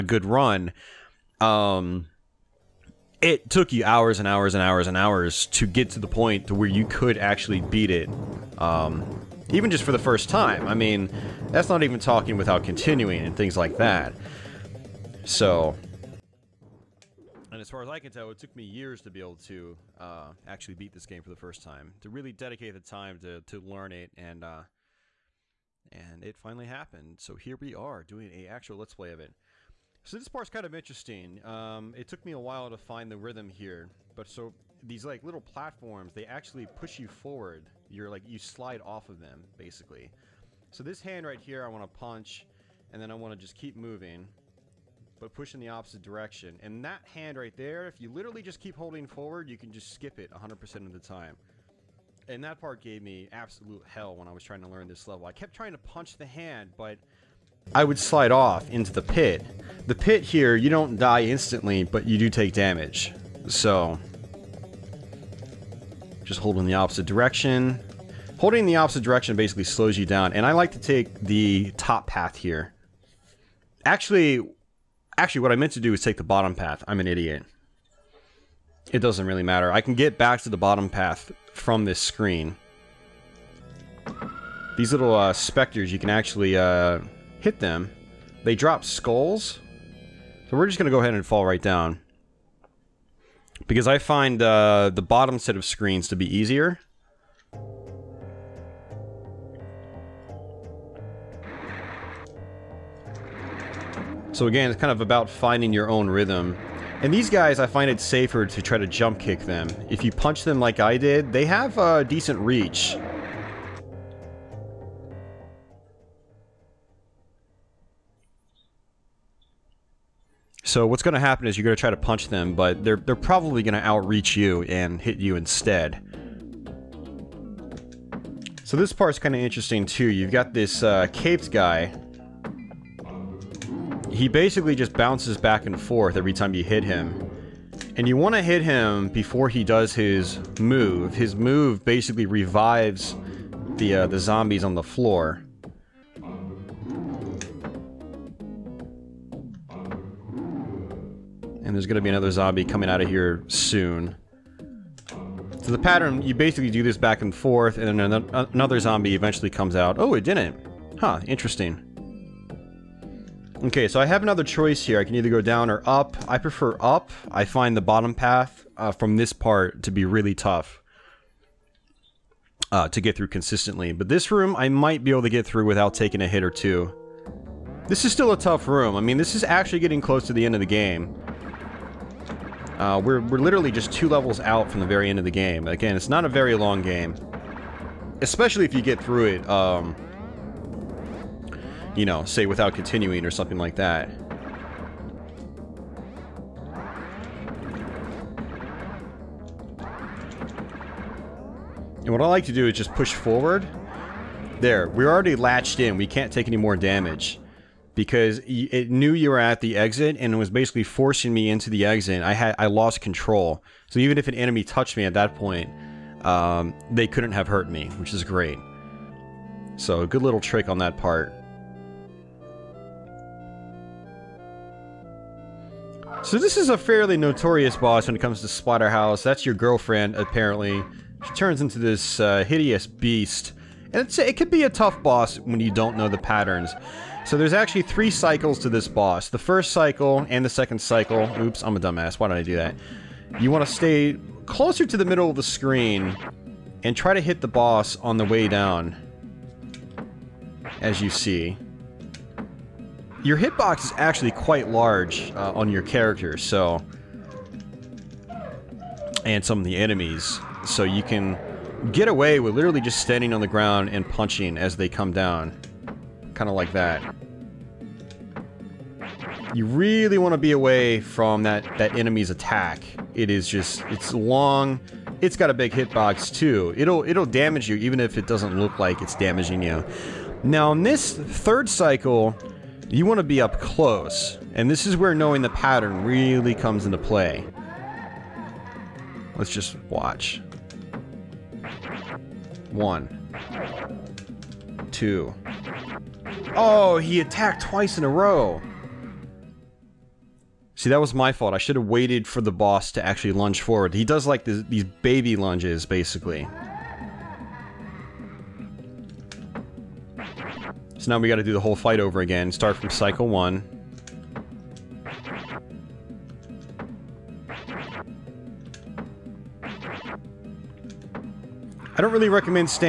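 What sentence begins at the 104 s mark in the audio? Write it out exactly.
So again, it's kind of about finding your own rhythm.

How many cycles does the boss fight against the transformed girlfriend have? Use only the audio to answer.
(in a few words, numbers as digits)
3.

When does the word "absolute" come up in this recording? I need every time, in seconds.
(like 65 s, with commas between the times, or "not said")
53 s.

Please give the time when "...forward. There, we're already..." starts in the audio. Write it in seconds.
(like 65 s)
203 s.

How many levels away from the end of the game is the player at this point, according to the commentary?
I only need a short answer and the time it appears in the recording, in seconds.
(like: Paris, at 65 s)
2, at 183 s.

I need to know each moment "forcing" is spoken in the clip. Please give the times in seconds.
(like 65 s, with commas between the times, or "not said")
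210 s.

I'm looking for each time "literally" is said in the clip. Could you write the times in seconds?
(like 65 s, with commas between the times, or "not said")
48 s, 183 s, 262 s.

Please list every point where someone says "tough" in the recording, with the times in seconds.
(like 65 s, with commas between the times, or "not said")
170 s, 178 s, 234 s.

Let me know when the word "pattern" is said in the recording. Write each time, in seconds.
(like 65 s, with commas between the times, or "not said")
155 s, 236 s, 285 s.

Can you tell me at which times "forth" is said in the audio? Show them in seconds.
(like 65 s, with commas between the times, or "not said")
135 s, 157 s.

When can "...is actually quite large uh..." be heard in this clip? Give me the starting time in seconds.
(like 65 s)
253 s.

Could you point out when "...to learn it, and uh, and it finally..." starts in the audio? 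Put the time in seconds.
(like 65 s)
23 s.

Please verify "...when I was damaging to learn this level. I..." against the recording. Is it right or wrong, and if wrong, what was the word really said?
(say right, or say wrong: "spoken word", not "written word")
wrong: "trying", not "damaging".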